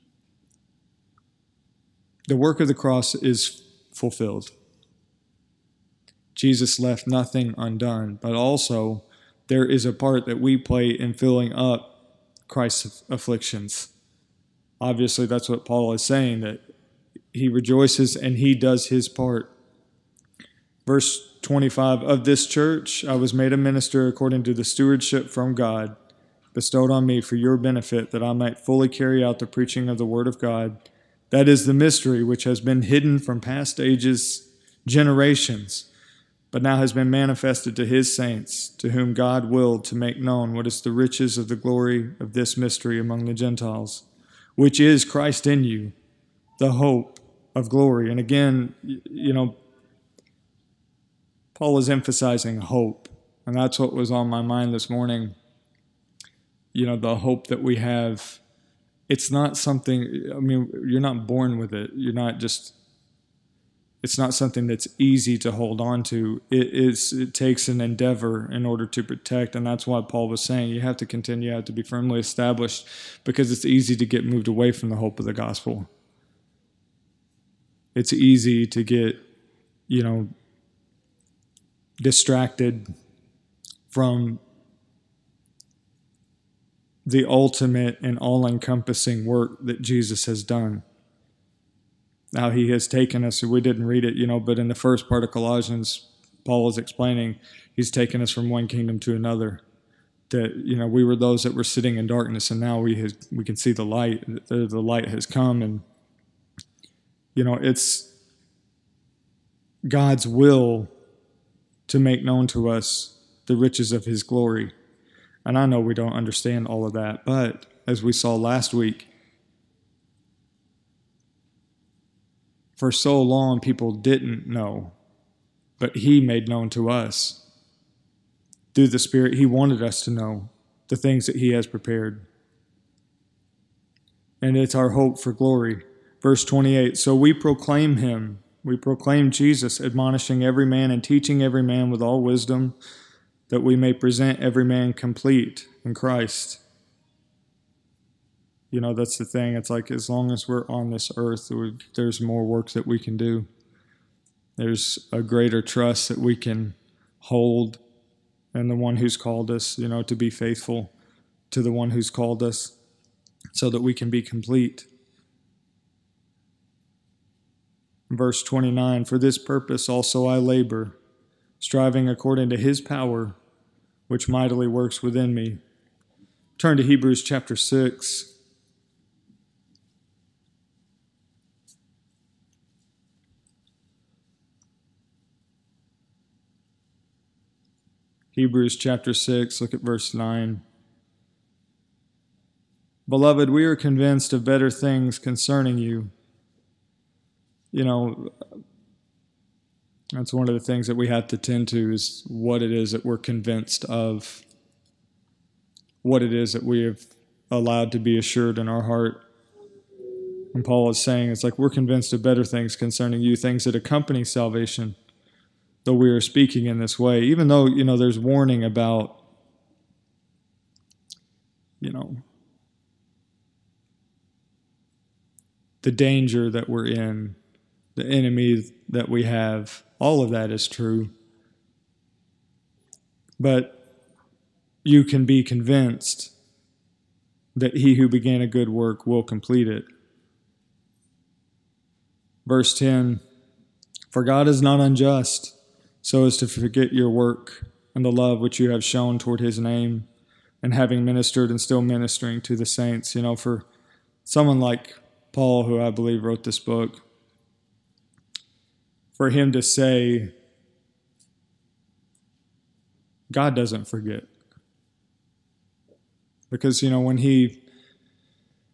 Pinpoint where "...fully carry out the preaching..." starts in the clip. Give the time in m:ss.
0:28.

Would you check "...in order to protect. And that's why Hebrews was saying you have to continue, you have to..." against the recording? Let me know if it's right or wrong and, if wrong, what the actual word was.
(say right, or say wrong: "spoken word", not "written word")
wrong: "Paul", not "Hebrews".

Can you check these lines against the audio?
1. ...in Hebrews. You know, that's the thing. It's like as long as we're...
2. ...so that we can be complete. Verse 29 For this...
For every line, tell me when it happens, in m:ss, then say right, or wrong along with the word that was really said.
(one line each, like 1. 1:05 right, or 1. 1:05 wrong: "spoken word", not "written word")
1. 2:25 wrong: "Christ", not "Hebrews"
2. 2:43 right.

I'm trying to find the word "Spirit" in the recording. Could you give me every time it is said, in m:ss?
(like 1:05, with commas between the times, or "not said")
2:08.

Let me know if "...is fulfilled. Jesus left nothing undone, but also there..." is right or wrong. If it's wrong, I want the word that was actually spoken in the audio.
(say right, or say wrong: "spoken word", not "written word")
right.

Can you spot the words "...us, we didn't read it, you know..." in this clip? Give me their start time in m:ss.
1:33.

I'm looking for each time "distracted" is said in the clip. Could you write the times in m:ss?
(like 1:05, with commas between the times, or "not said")
1:22.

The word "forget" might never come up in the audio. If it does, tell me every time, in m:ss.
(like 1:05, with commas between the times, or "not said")
4:06, 4:23.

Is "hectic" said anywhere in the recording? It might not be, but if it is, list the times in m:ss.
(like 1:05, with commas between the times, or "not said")
not said.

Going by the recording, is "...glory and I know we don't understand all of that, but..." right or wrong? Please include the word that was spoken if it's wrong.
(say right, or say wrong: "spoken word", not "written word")
right.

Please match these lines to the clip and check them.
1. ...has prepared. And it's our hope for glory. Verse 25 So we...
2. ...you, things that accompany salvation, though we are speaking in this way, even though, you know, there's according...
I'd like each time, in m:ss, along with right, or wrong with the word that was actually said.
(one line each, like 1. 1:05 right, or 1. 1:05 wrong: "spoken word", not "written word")
1. 2:11 wrong: "28", not "25"
2. 3:33 wrong: "warning", not "according".